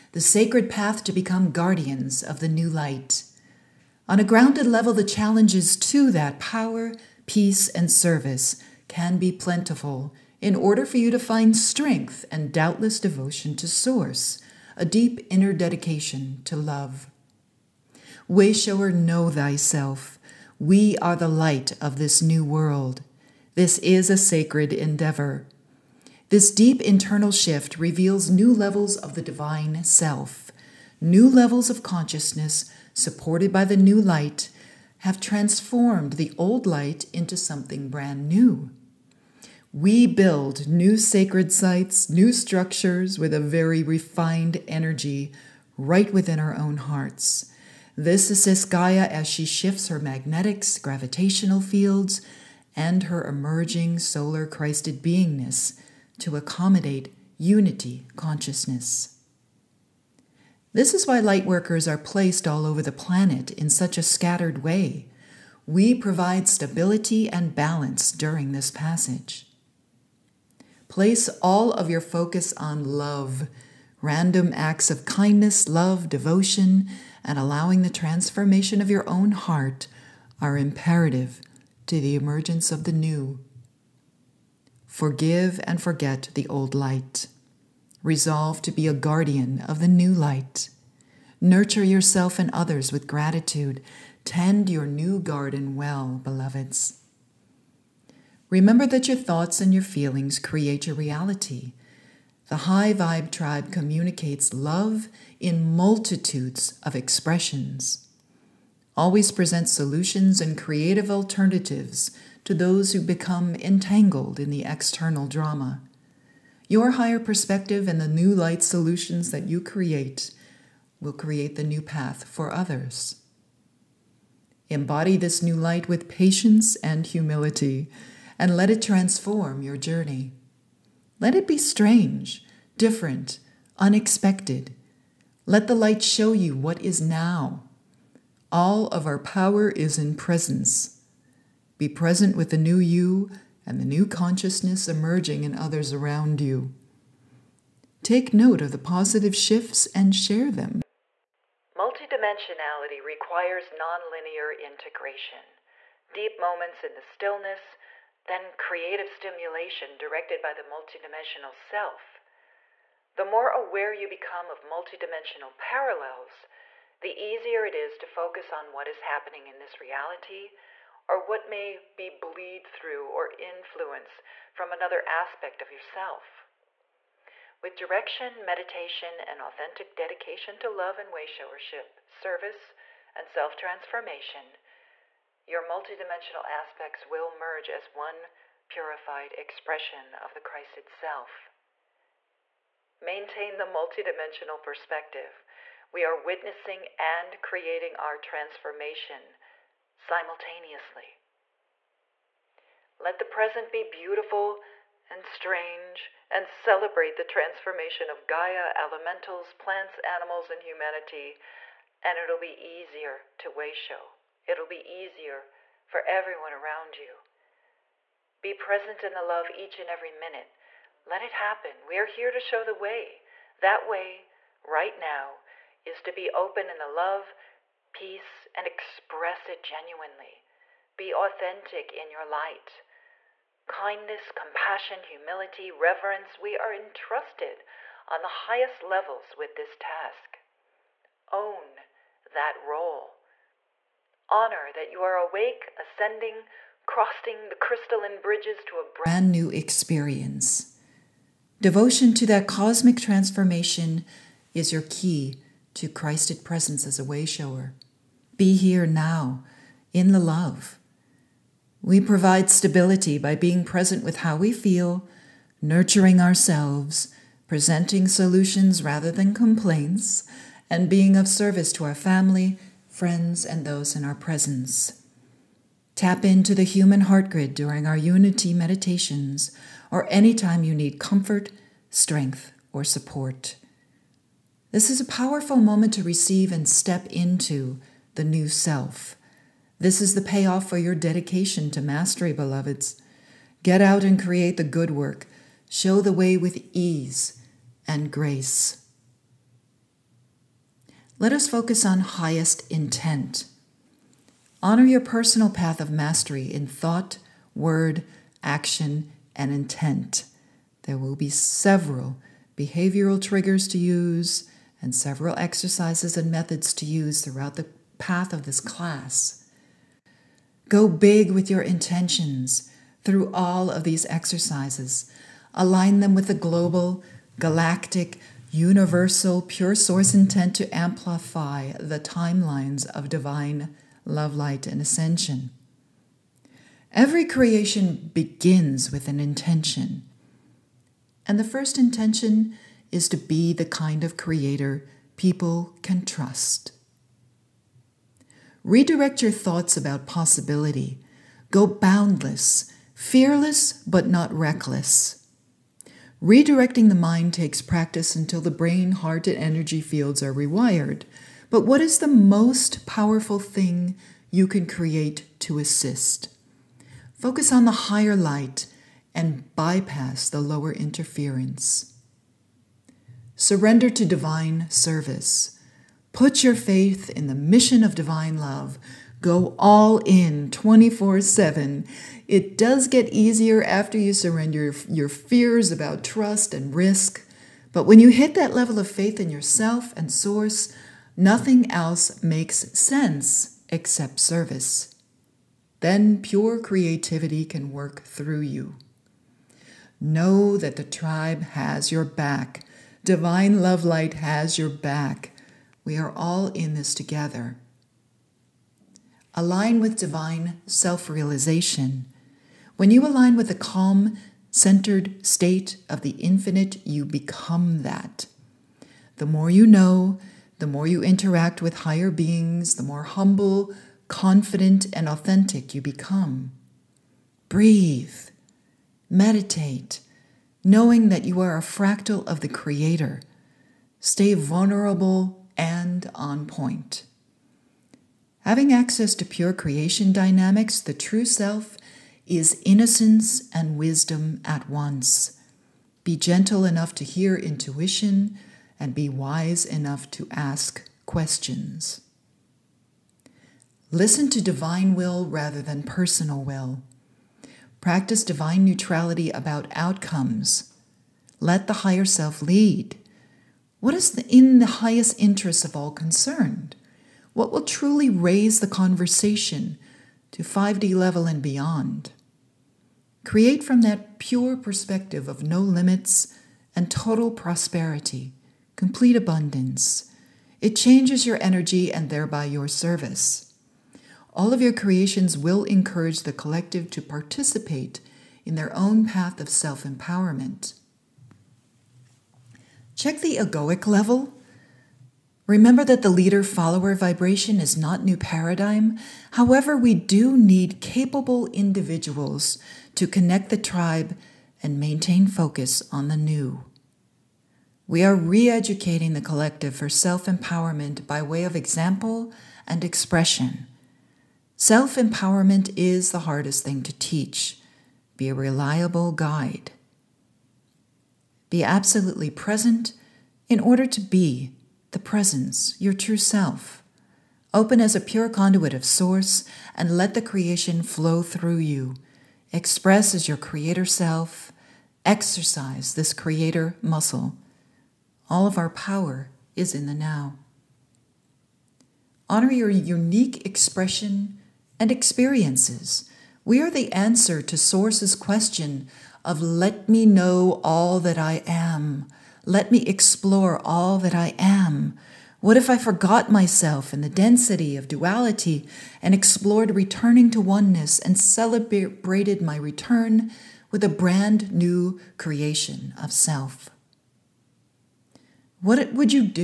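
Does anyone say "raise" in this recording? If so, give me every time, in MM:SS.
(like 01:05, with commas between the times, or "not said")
07:48.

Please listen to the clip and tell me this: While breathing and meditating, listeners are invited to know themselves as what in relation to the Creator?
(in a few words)
a fractal.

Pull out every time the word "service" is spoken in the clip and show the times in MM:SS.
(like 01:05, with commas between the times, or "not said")
00:07, 03:02, 04:31, 06:14, 06:34, 08:02.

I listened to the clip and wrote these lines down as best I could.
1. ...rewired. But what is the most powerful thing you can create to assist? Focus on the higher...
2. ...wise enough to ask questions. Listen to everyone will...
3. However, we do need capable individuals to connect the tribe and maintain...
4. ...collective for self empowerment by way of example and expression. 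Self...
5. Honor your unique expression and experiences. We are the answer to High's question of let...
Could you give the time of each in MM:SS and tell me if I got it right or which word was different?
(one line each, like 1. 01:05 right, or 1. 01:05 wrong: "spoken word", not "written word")
1. 06:00 right
2. 07:29 wrong: "divine", not "everyone"
3. 08:19 right
4. 08:29 right
5. 09:02 wrong: "Source", not "High".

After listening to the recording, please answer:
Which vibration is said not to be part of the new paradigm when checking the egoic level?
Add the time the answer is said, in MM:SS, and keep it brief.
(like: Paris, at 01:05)
leader follower, at 08:16.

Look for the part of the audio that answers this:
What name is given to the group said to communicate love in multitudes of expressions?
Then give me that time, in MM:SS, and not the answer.
01:42.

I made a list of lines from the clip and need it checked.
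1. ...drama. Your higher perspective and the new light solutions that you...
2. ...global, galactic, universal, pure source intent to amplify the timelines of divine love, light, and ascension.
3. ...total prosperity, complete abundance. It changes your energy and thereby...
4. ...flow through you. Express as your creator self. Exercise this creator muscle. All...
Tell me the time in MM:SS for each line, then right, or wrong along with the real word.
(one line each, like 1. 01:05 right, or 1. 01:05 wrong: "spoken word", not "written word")
1. 01:55 right
2. 05:26 right
3. 07:56 right
4. 08:50 right.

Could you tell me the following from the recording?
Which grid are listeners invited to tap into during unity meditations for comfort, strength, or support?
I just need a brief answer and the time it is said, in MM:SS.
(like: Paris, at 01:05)
human heart grid, at 04:36.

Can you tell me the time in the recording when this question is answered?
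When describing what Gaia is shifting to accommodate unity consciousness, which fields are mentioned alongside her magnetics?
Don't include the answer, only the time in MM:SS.
00:50.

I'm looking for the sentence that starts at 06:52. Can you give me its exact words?
When you align with the calm, centered state of the infinite, you become that.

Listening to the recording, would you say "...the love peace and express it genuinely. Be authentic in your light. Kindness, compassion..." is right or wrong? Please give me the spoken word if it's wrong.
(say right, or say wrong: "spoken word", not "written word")
right.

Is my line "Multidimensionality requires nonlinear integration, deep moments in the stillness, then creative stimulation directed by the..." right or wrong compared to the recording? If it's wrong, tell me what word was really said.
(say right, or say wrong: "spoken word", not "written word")
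right.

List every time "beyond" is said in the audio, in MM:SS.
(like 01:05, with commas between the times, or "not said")
07:51.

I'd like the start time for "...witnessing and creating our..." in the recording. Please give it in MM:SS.
03:16.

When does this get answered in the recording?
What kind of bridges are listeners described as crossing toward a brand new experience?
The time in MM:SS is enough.
04:07.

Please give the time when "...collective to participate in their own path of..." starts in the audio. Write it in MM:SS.
08:06.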